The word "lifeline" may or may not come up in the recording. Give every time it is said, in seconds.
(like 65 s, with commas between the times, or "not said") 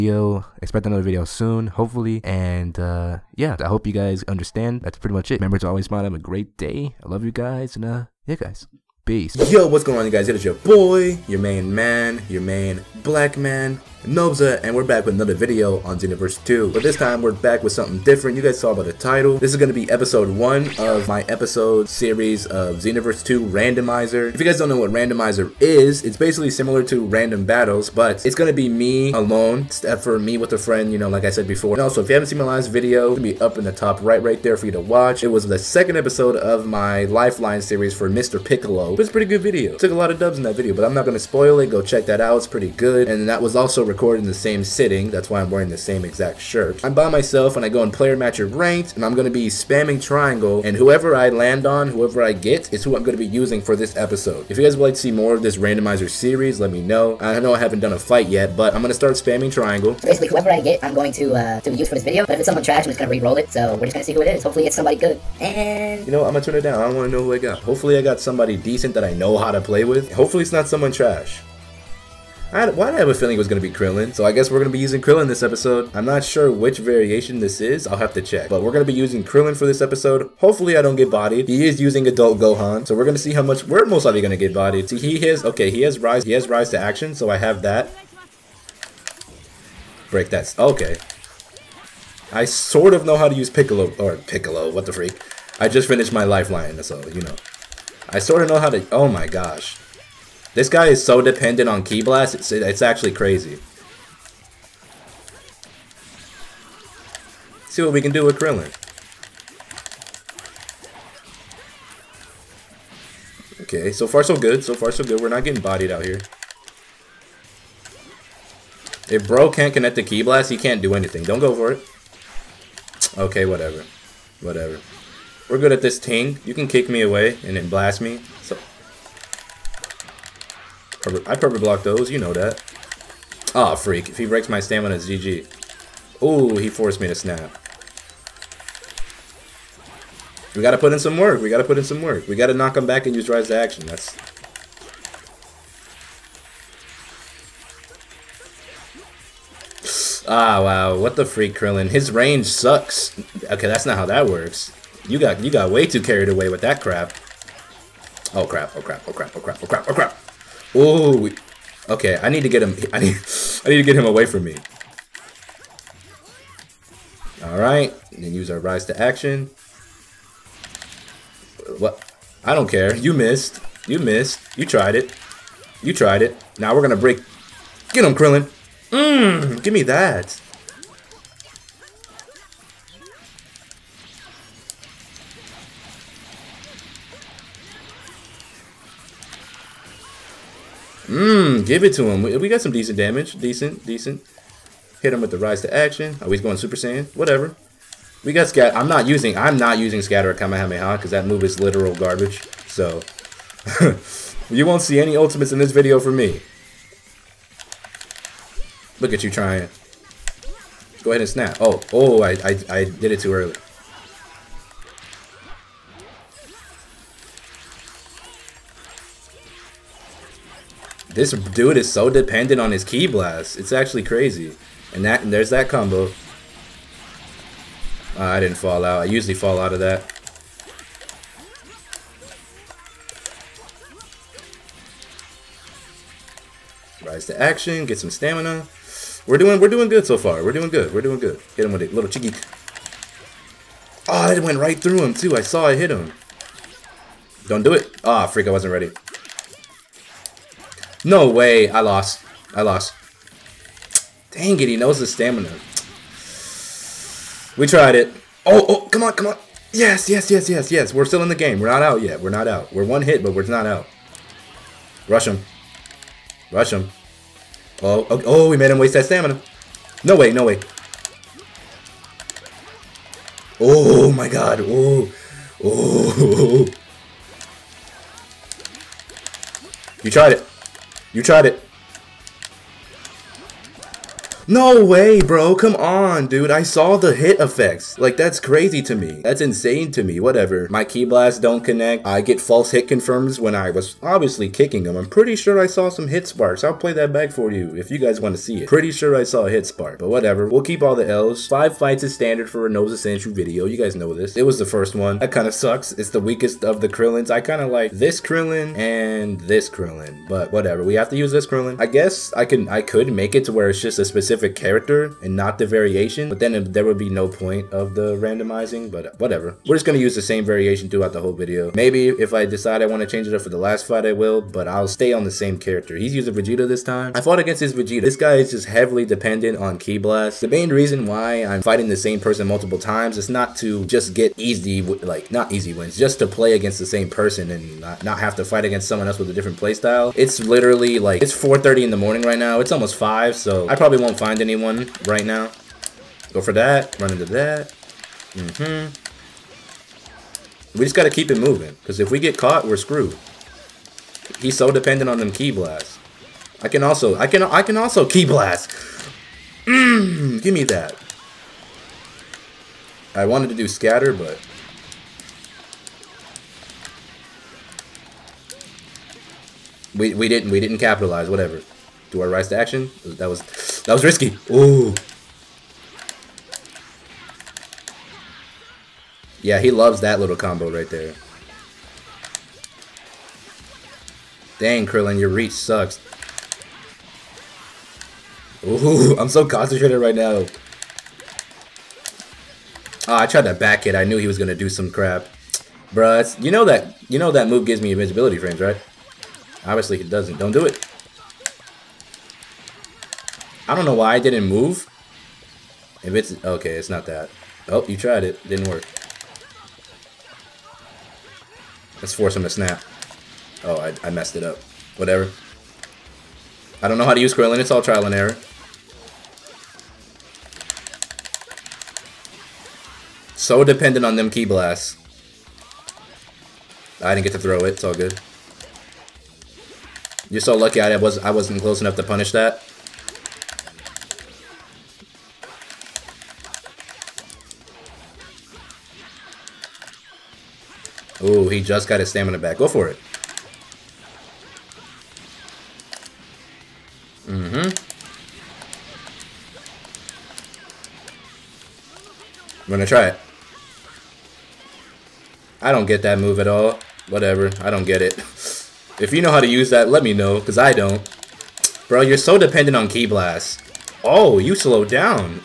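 37 s, 96 s.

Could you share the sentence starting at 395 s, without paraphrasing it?
Bruh, you know that you know that move gives me invisibility frames, right?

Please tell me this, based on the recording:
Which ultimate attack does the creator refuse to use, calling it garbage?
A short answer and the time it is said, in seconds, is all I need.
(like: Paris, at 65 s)
scatter Kamehameha, at 200 s.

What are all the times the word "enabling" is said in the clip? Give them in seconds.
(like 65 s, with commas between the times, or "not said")
not said.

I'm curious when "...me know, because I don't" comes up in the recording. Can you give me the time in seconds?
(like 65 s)
460 s.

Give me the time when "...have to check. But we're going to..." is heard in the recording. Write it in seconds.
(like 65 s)
77 s.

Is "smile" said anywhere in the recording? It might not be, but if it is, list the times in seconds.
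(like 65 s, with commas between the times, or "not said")
5 s.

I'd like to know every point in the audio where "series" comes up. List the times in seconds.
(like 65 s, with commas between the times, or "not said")
21 s, 37 s, 56 s.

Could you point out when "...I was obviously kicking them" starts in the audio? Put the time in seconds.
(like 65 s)
293 s.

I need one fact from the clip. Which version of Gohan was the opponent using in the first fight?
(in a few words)
adult Gohan.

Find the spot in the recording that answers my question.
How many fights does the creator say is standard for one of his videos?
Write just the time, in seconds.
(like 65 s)
301 s.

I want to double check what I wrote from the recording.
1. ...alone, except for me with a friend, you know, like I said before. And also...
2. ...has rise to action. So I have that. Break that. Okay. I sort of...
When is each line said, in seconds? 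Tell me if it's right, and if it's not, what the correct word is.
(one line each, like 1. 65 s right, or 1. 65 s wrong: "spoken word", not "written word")
1. 29 s right
2. 86 s right.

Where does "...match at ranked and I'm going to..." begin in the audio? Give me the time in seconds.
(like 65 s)
48 s.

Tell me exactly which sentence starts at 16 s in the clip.
But this time, we're back with something different.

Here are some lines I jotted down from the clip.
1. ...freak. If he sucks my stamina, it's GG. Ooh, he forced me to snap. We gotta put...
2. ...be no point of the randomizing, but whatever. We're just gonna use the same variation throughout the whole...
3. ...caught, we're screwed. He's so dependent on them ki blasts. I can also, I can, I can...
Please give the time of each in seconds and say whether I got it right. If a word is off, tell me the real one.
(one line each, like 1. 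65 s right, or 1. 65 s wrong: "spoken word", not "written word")
1. 133 s wrong: "breaks", not "sucks"
2. 316 s right
3. 352 s right.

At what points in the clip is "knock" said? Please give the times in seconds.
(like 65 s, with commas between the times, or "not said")
142 s.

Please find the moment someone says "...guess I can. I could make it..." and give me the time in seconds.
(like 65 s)
311 s.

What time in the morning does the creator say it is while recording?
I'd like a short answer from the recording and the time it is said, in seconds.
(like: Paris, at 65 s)
4:30, at 341 s.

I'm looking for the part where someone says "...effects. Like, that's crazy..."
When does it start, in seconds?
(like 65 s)
287 s.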